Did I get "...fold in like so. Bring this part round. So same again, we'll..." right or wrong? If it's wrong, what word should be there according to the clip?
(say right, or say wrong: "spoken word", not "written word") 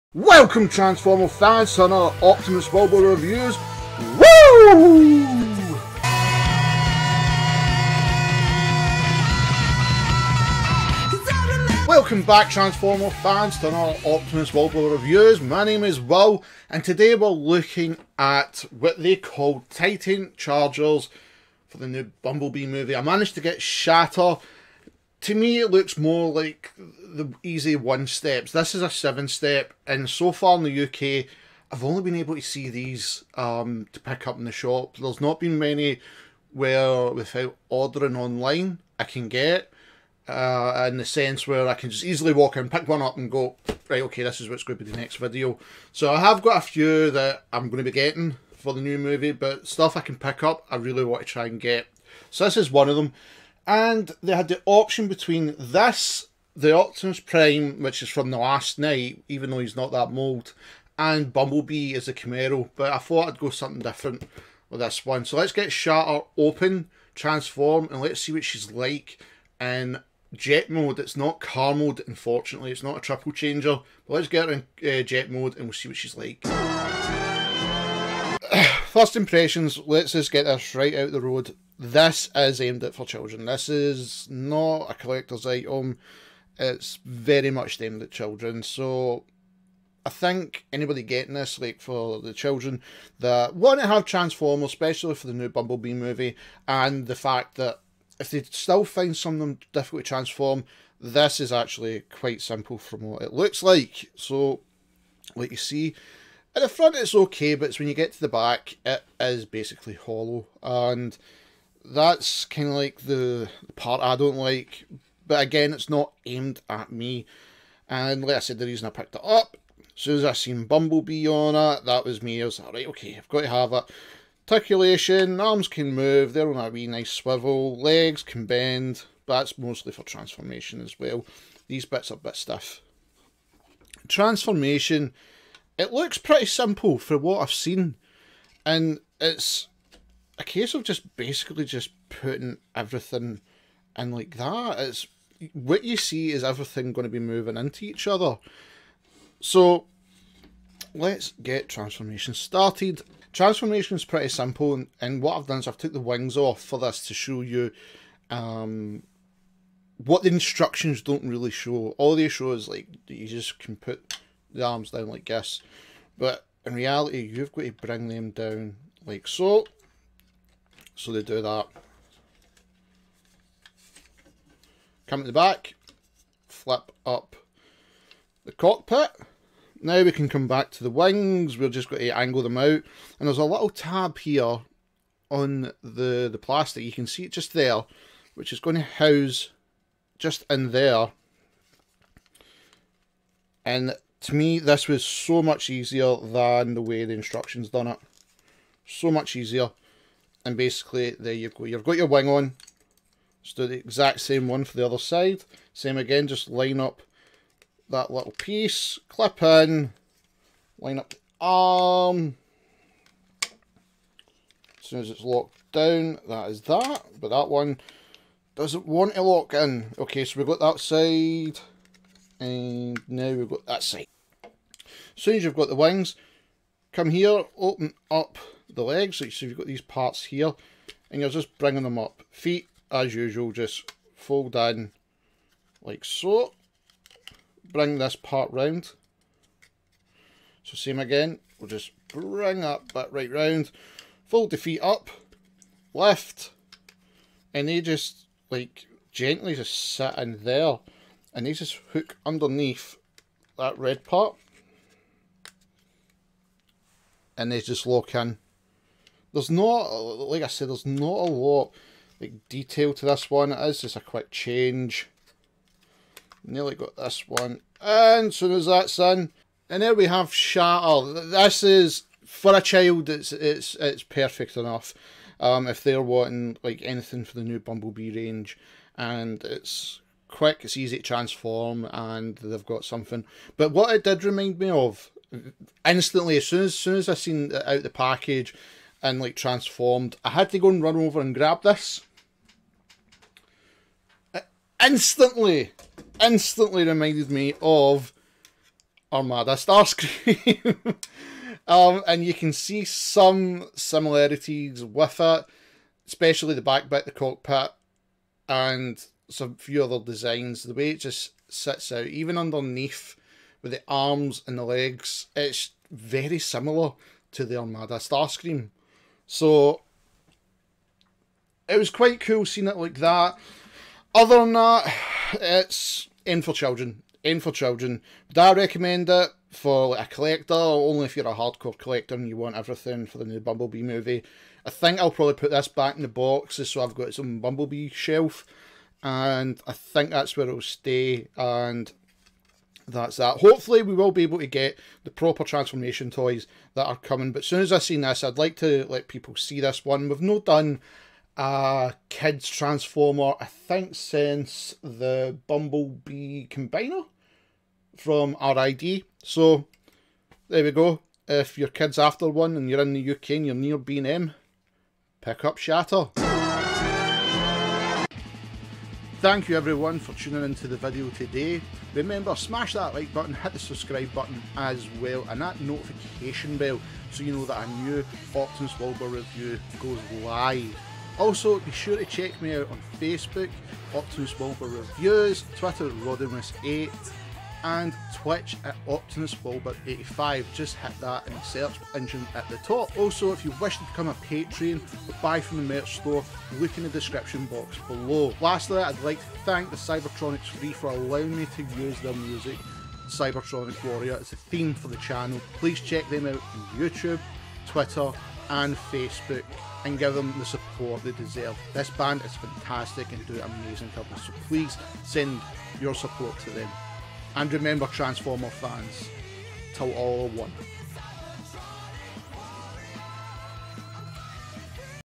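right.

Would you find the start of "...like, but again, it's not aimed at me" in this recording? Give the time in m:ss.
1:54.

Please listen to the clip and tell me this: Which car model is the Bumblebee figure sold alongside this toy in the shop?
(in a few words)
Camaro.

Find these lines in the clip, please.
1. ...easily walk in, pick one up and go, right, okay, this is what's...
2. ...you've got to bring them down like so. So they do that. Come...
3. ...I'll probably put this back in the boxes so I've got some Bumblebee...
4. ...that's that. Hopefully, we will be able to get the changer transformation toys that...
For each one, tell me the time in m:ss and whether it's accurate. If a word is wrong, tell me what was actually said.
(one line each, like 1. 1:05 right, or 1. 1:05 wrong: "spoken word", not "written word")
1. 0:42 right
2. 2:47 right
3. 5:34 right
4. 5:42 wrong: "proper", not "changer".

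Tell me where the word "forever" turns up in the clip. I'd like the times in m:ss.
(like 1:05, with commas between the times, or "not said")
not said.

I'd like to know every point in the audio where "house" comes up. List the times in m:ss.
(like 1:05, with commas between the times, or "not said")
3:08.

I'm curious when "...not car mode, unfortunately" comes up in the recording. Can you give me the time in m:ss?
1:11.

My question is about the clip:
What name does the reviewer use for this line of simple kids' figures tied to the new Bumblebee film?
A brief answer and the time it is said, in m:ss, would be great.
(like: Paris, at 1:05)
Titan Changers, at 0:19.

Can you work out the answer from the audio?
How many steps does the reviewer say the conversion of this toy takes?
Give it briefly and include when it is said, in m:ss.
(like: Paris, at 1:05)
Seven, at 0:28.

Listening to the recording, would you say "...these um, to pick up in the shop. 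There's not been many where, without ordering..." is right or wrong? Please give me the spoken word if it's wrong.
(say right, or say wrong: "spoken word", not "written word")
right.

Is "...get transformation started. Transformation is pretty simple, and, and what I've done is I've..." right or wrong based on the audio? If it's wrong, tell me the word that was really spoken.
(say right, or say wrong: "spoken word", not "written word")
right.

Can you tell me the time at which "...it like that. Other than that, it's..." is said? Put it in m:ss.
5:22.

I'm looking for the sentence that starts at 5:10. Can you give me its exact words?
The way it just sits out, even underneath with the arms and the legs, it's very similar to the Armada Starscream.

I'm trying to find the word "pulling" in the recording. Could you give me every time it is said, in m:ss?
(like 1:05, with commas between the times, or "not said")
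not said.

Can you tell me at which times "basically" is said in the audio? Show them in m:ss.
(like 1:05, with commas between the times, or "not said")
1:49, 2:21, 3:20.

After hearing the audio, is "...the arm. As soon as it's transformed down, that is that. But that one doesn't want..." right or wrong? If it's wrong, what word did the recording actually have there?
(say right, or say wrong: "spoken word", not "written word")
wrong: "locked", not "transformed".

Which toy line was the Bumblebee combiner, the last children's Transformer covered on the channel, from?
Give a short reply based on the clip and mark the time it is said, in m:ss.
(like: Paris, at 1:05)
RID, at 5:58.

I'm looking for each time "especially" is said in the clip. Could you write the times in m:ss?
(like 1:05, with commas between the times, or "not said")
1:34, 5:06.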